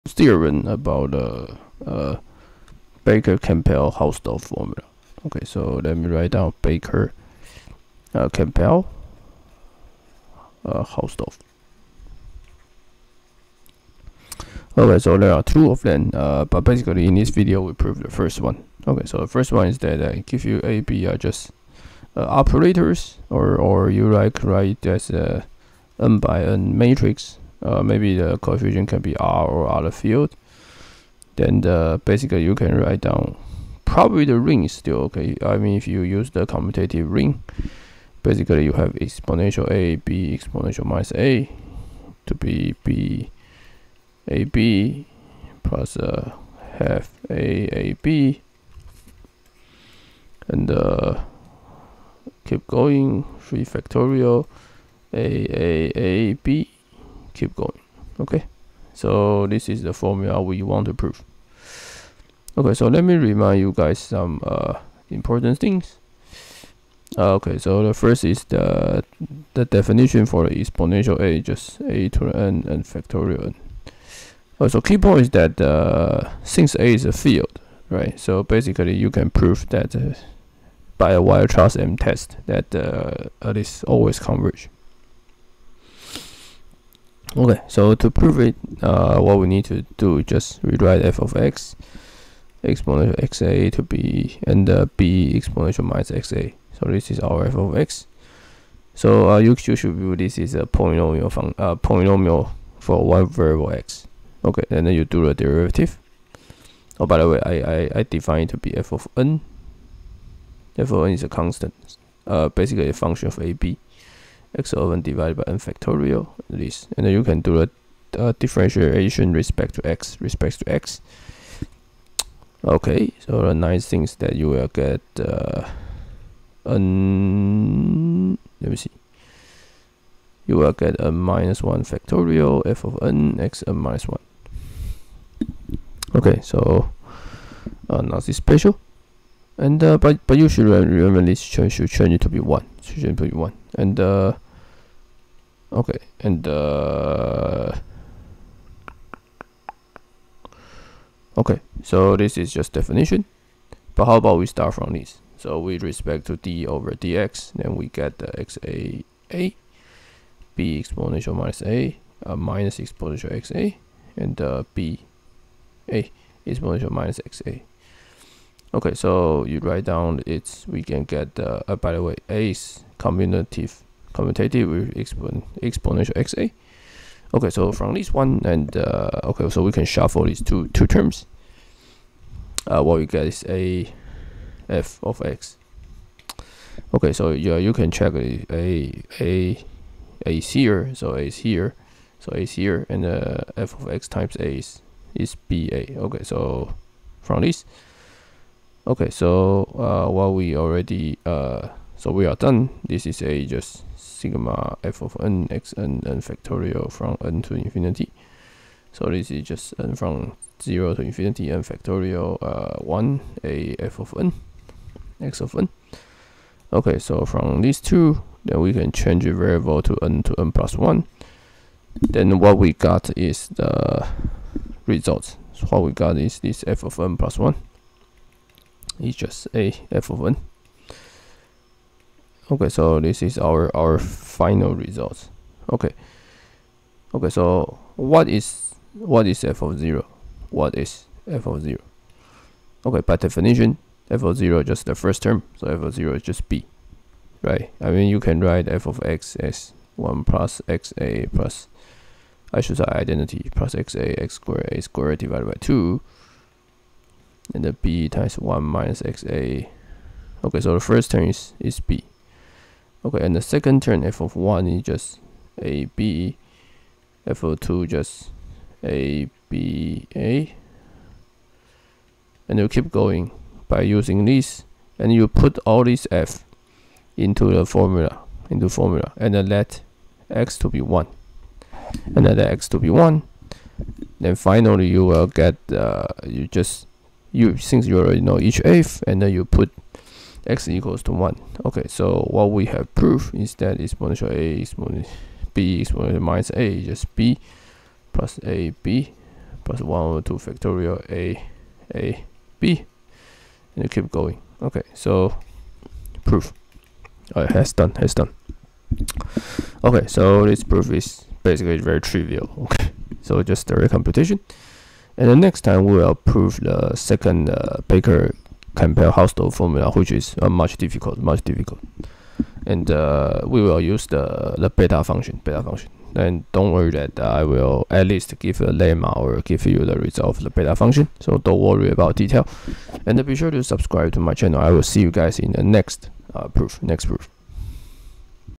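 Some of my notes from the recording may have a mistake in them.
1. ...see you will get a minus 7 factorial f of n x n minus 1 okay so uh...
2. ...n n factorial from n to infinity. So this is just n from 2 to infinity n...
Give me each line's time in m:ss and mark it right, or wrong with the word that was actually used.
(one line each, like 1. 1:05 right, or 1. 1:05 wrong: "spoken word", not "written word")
1. 2:08 wrong: "1", not "7"
2. 3:25 wrong: "0", not "2".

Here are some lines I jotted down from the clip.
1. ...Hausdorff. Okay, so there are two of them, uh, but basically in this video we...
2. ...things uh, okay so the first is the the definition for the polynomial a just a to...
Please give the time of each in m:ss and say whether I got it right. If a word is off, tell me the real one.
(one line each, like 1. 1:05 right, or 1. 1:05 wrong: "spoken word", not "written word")
1. 0:10 right
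2. 1:05 wrong: "exponential", not "polynomial".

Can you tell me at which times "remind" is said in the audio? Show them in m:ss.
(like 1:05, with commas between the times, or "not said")
1:03.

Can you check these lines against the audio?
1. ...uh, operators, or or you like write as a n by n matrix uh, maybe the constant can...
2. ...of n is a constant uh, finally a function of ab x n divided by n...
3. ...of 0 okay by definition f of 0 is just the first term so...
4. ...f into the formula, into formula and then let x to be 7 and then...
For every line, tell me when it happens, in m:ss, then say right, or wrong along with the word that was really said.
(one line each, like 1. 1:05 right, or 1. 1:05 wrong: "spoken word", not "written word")
1. 0:22 wrong: "coefficient", not "constant"
2. 1:50 wrong: "basically", not "finally"
3. 4:01 right
4. 4:36 wrong: "1", not "7".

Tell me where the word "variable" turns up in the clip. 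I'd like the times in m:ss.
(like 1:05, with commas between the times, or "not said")
1:43, 3:39.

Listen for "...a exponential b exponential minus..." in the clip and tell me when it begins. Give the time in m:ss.
4:54.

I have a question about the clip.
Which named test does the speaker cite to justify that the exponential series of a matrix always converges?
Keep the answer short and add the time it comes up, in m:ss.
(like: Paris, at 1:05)
Weierstrass M test, at 1:21.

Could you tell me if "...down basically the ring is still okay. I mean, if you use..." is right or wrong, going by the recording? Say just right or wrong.
wrong.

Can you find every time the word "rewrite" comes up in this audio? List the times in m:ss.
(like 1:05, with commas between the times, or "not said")
1:30.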